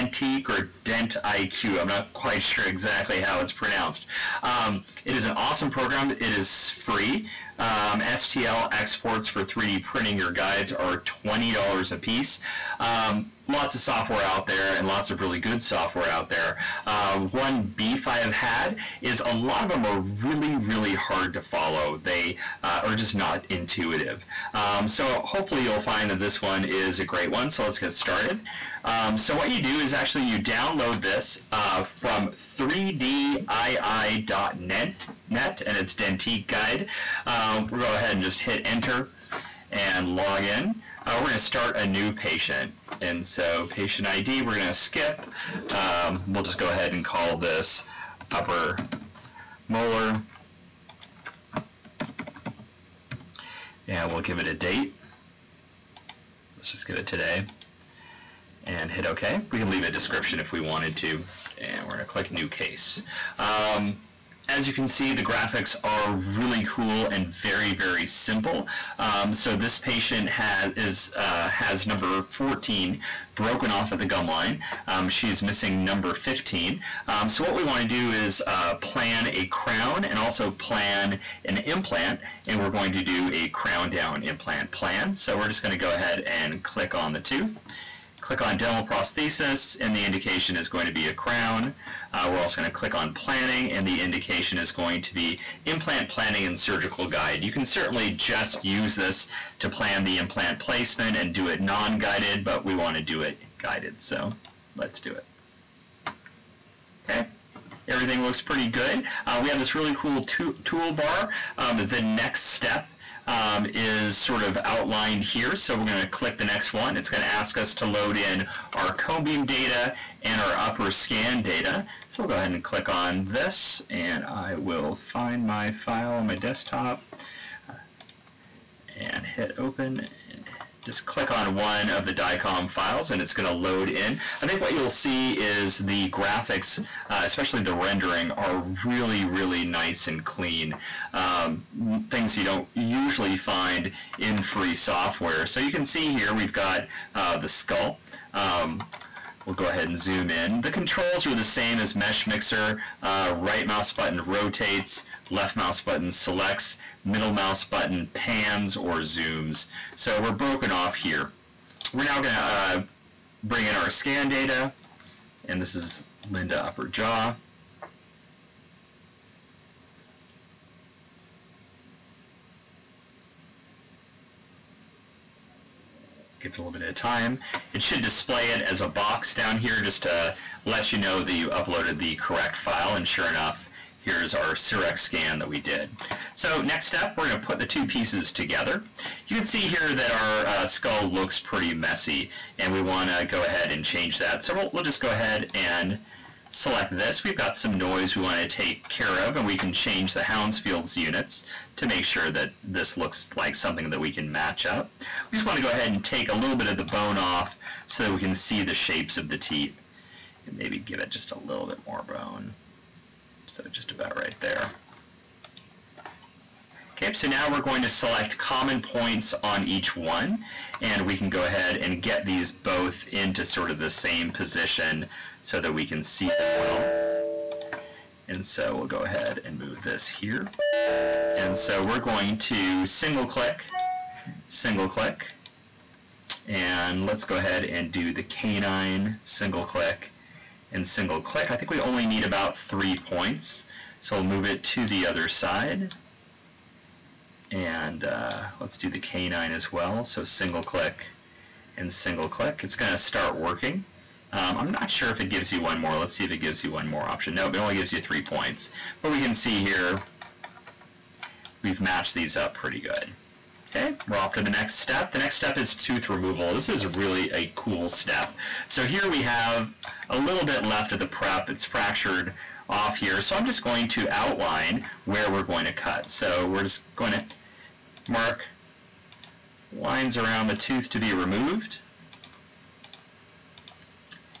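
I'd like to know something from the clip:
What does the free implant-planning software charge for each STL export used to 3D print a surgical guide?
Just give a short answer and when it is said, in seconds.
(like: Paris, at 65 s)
$20, at 11 s.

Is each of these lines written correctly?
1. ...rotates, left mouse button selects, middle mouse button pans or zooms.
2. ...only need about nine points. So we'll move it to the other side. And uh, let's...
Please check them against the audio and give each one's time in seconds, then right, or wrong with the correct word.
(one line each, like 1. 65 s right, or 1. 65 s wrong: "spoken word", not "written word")
1. 154 s right
2. 241 s wrong: "three", not "nine".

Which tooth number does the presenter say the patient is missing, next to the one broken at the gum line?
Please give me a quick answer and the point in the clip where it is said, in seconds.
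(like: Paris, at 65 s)
15, at 75 s.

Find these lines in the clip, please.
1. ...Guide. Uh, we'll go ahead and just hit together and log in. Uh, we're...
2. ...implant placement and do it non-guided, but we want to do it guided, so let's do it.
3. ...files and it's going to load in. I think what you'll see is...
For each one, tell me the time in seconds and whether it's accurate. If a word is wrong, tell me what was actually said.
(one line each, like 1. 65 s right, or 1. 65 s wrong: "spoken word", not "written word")
1. 36 s wrong: "enter", not "together"
2. 100 s right
3. 132 s right.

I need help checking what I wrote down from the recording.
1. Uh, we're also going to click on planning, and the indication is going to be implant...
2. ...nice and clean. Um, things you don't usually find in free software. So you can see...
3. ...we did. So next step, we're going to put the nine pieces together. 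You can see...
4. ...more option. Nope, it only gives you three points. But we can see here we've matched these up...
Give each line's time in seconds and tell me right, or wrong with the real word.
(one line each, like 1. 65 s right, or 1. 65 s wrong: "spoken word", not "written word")
1. 92 s right
2. 139 s right
3. 185 s wrong: "two", not "nine"
4. 256 s right.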